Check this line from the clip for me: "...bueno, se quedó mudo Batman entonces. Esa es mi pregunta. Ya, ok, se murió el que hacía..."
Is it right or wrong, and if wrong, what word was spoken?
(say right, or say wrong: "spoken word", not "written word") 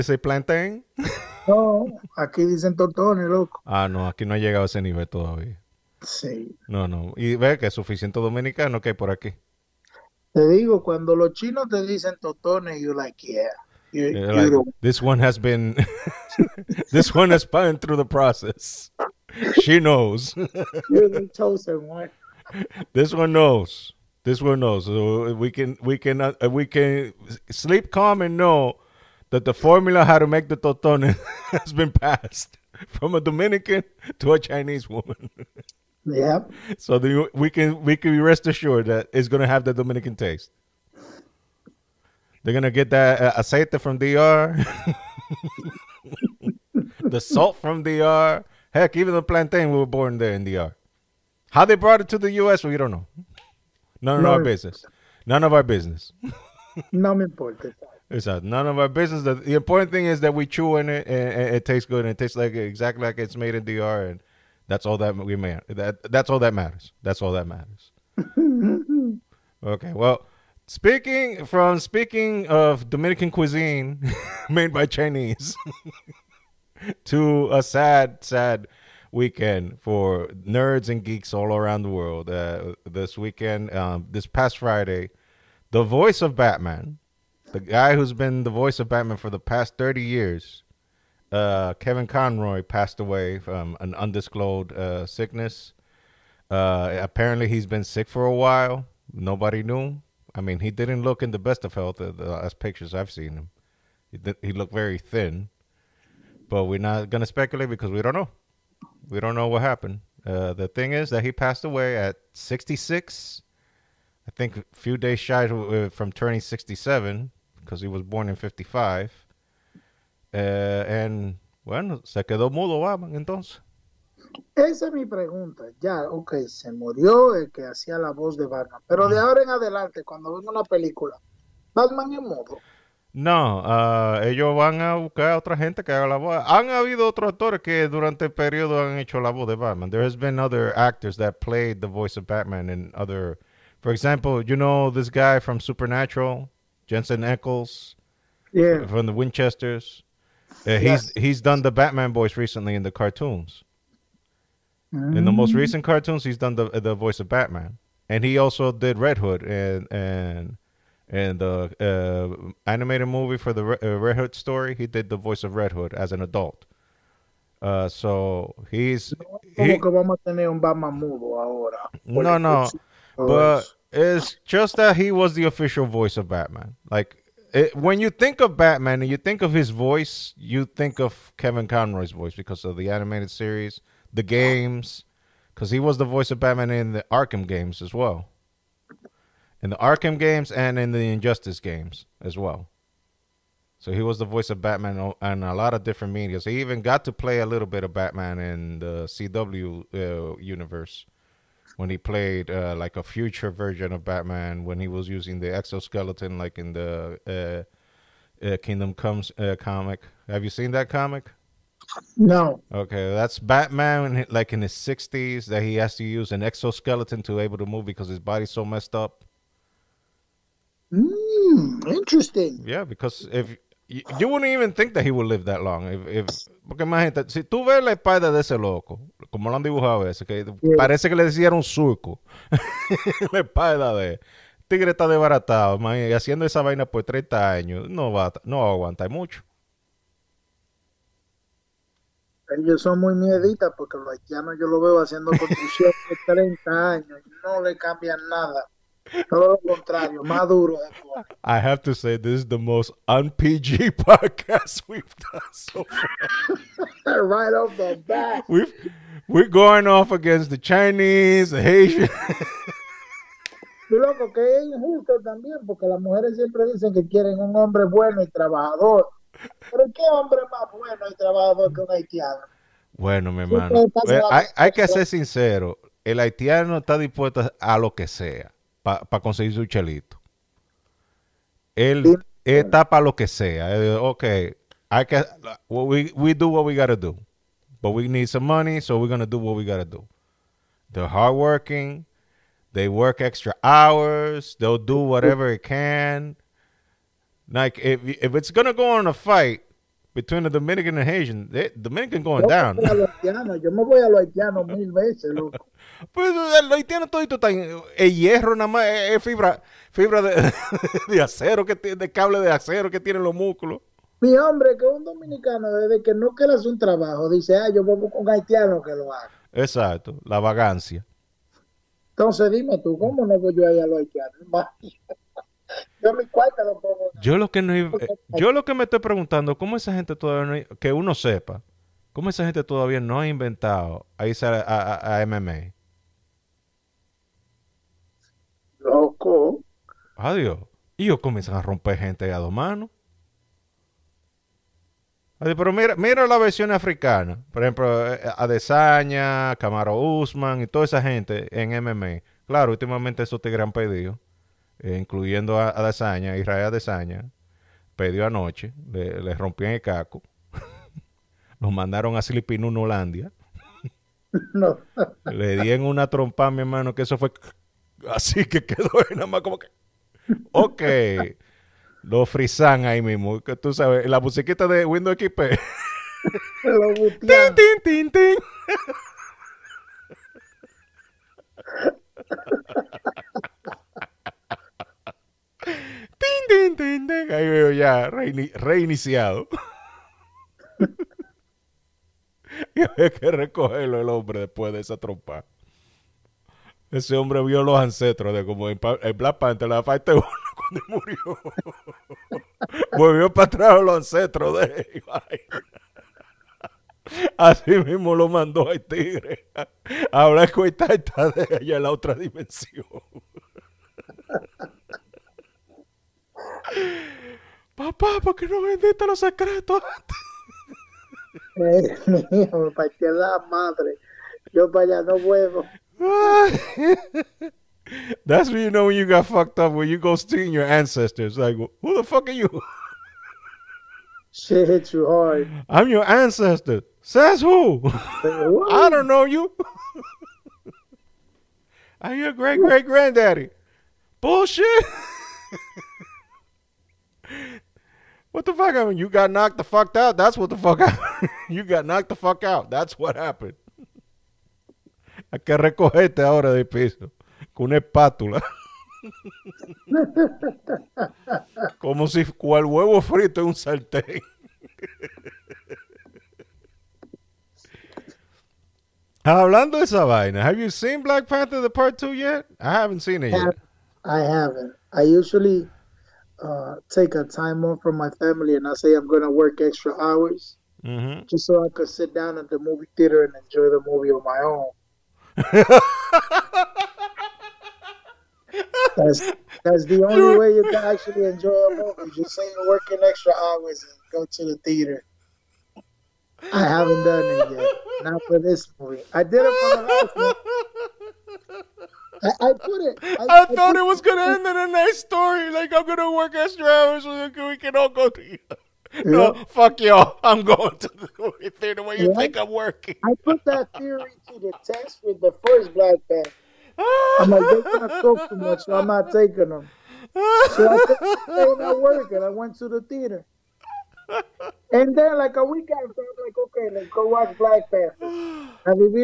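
right.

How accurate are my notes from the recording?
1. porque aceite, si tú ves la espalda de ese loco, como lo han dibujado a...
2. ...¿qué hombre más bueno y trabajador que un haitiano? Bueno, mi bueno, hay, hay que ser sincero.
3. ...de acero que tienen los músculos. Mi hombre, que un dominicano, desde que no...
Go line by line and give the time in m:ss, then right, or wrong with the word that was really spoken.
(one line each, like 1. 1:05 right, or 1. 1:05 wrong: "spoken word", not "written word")
1. 3:46 wrong: "imagínate", not "aceite"
2. 4:29 wrong: "hermano", not "bueno"
3. 5:12 right.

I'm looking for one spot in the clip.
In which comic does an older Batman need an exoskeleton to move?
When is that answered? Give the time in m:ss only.
3:28.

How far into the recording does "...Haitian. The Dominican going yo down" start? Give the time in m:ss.
5:01.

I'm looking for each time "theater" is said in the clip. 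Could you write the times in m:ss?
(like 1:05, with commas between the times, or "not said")
8:02, 8:14, 8:31, 8:42.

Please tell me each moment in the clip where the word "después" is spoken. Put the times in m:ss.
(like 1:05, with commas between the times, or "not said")
6:34.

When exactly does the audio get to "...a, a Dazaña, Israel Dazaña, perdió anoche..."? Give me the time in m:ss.
5:55.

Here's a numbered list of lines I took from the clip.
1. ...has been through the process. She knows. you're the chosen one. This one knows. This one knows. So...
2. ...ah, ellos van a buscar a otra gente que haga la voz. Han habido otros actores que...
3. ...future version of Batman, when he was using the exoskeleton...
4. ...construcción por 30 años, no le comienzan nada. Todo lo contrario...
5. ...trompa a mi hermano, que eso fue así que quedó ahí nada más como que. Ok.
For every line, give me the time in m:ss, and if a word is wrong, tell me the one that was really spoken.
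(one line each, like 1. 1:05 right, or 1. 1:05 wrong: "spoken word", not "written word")
1. 0:17 right
2. 2:13 right
3. 3:23 right
4. 4:05 wrong: "cambian", not "comienzan"
5. 6:06 right.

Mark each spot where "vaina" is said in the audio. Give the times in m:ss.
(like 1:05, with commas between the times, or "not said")
3:56, 7:50.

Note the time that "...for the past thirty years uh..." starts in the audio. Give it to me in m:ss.
1:29.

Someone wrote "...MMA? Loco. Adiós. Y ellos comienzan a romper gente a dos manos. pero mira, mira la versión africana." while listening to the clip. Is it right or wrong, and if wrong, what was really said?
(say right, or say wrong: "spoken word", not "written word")
right.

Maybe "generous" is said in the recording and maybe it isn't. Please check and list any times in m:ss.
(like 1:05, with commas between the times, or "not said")
not said.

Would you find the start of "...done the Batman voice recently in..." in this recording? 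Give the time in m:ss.
2:31.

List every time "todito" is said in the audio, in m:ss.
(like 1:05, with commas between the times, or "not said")
5:07.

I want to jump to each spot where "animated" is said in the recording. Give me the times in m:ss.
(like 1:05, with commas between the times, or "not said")
2:42, 3:02.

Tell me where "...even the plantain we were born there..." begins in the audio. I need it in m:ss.
0:48.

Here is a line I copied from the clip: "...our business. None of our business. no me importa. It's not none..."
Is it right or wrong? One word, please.
right.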